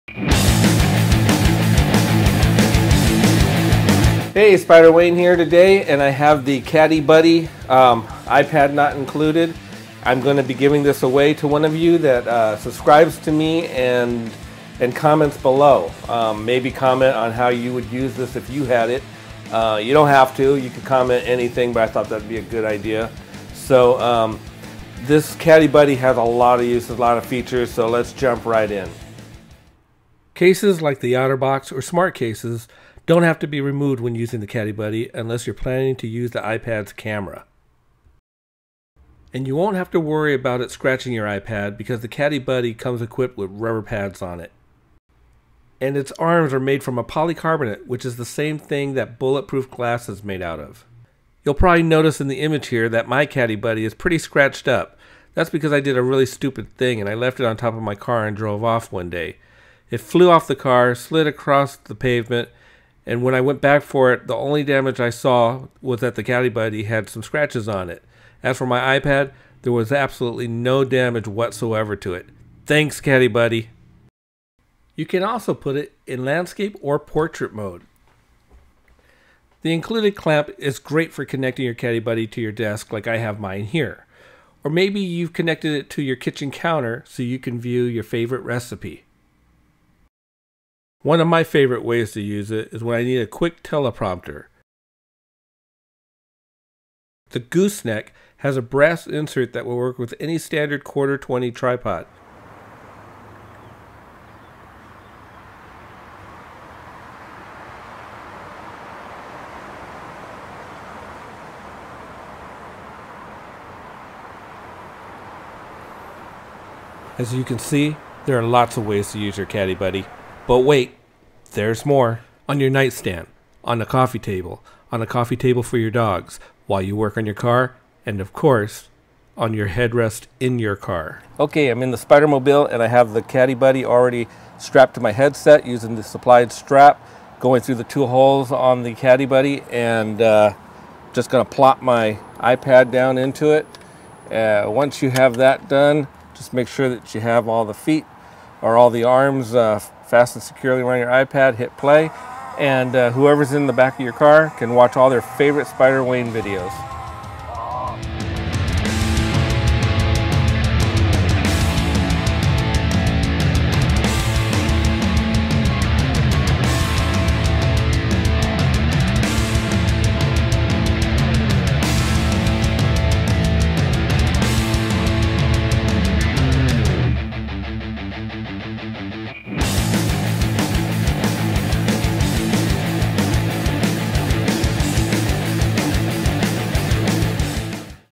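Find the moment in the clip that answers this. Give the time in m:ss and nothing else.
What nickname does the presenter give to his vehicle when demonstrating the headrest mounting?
2:11.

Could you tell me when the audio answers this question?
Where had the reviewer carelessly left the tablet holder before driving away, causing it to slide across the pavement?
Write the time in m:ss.
0:57.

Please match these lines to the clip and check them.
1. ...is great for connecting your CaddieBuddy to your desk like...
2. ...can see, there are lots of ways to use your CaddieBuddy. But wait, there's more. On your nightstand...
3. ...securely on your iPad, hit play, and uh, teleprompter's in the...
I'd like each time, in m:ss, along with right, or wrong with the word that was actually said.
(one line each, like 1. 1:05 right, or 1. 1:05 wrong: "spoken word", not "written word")
1. 1:20 right
2. 1:57 right
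3. 2:30 wrong: "whoever", not "teleprompter".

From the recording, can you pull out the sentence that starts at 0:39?
And you won't have to worry about it scratching your iPad because the CaddieBuddy comes equipped with rubber pads on it.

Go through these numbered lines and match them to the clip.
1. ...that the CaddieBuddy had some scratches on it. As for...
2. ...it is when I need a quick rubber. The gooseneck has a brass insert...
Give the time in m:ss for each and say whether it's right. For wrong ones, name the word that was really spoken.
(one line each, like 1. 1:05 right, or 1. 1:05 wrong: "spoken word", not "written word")
1. 1:06 right
2. 1:32 wrong: "teleprompter", not "rubber".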